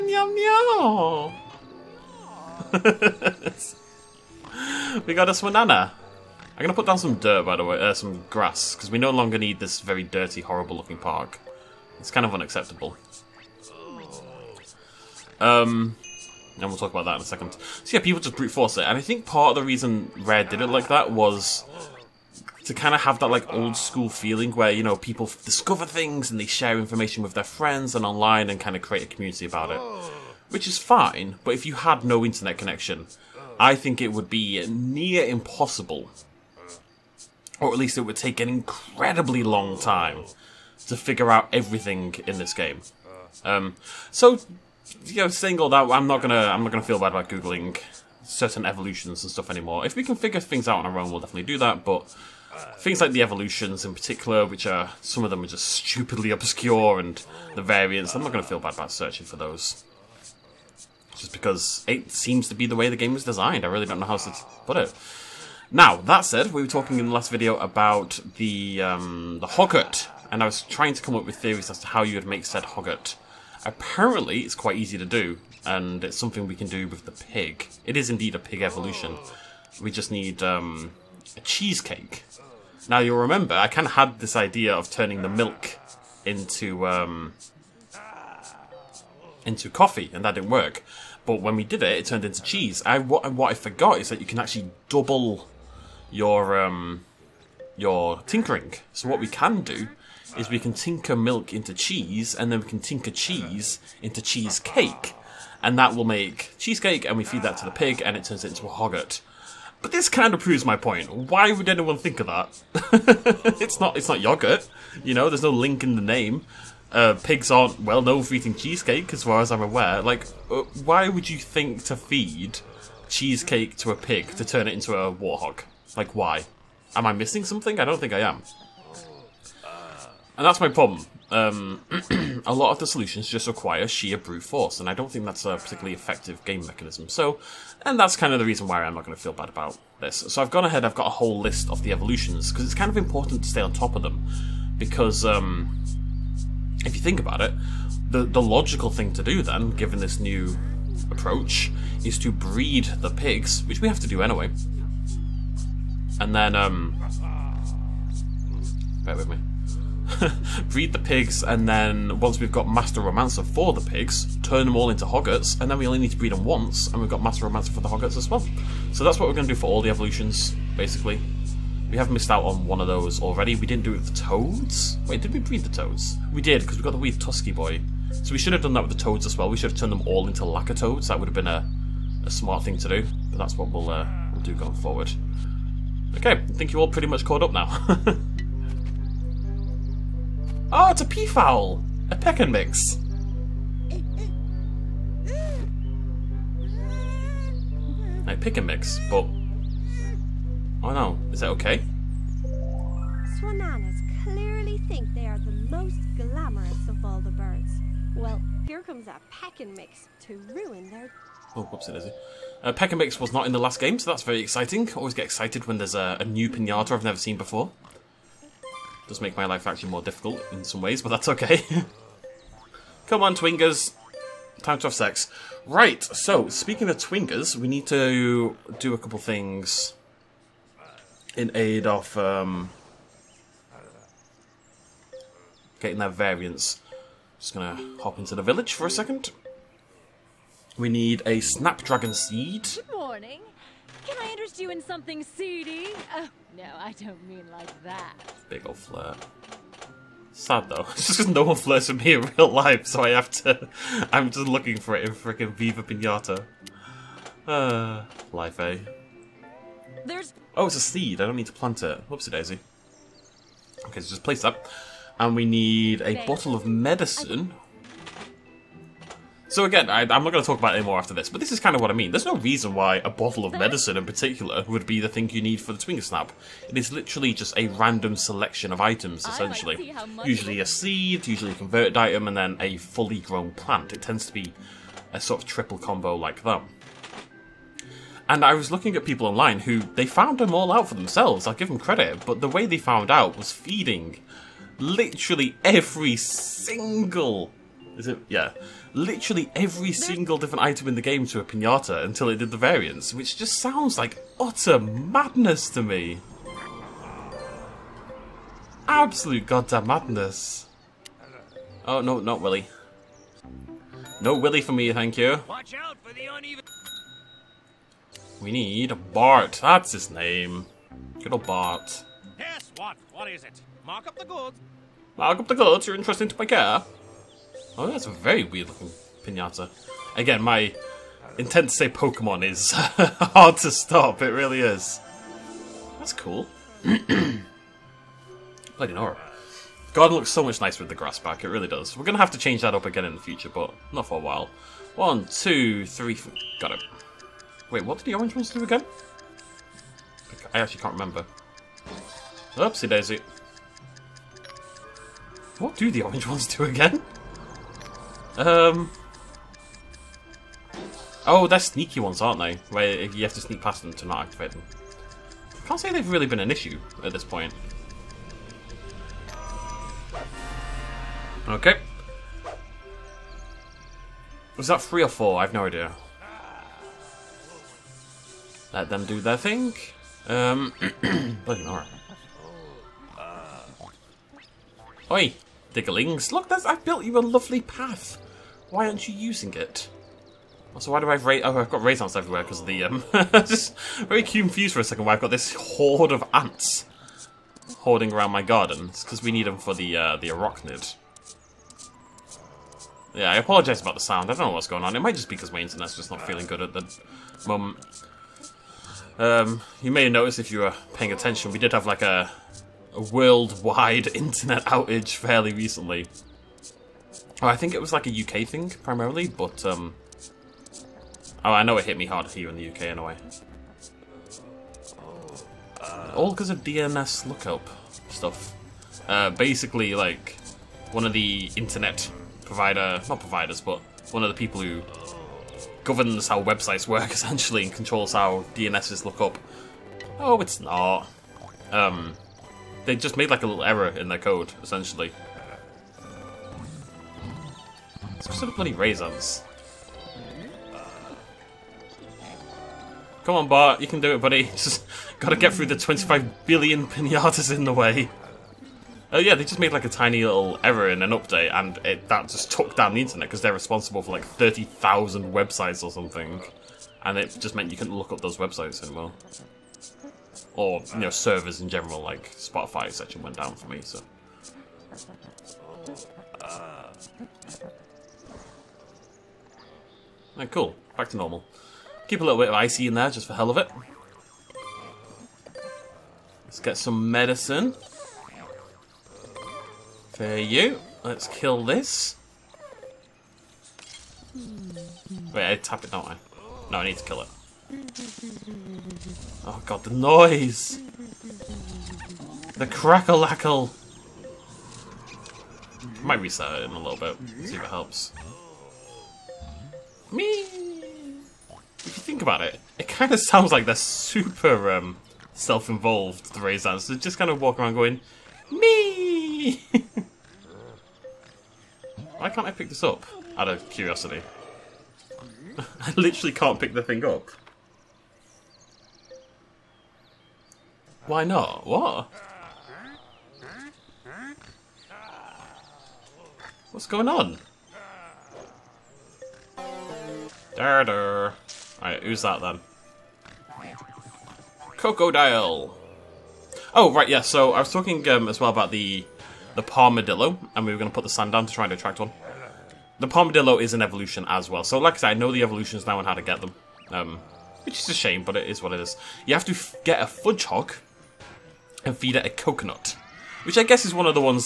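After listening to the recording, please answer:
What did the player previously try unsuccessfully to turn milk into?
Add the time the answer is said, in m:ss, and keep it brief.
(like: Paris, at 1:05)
Coffee, at 1:29.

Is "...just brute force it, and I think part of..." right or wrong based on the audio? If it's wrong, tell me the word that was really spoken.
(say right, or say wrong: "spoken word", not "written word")
right.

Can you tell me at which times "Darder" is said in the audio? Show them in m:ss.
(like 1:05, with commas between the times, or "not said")
9:00.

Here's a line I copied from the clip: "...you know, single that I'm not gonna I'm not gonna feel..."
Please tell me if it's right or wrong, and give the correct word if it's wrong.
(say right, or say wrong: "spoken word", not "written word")
right.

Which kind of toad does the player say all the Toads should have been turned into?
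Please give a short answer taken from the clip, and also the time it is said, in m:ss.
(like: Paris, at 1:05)
Lacquer Toads, at 3:00.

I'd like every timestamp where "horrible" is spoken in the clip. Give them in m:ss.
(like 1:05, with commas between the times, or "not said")
0:10.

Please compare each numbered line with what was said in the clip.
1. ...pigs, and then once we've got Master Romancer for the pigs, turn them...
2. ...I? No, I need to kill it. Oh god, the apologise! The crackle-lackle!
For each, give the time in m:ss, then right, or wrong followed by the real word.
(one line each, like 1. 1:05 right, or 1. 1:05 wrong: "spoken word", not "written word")
1. 2:40 right
2. 8:16 wrong: "noise", not "apologise".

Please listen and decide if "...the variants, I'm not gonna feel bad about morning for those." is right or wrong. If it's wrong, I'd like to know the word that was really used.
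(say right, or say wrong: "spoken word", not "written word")
wrong: "searching", not "morning".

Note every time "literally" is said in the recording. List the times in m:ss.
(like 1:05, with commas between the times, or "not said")
4:36, 4:54, 4:58, 8:45.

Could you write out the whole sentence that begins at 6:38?
It's because we need them for the, uh, the arachnid.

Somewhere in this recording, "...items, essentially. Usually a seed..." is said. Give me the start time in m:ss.
4:38.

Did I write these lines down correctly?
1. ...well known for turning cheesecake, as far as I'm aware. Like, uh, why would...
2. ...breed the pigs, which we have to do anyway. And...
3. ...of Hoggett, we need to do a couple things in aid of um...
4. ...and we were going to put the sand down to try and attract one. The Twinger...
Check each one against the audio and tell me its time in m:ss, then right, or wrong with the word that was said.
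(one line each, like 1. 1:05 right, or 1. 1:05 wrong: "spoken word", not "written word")
1. 1:57 wrong: "eating", not "turning"
2. 2:32 right
3. 3:46 wrong: "Twingers", not "Hoggett"
4. 9:10 wrong: "Palmadillo", not "Twinger".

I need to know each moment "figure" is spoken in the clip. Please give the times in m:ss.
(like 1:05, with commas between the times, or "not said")
0:40, 0:50.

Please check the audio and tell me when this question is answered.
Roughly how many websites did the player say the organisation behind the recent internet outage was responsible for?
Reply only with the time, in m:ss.
7:44.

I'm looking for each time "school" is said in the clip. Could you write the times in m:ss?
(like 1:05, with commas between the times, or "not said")
0:23.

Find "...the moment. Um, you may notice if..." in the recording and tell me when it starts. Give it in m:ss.
6:46.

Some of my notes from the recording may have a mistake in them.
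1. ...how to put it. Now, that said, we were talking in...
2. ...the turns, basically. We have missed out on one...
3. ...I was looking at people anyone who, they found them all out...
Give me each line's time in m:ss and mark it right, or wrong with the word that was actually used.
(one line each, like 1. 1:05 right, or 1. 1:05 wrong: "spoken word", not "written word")
1. 1:04 right
2. 2:49 wrong: "evolutions", not "turns"
3. 4:48 wrong: "online", not "anyone".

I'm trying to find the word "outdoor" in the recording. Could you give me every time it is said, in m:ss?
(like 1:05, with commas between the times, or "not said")
not said.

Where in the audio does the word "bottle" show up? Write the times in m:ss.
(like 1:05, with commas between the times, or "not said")
4:26, 4:33.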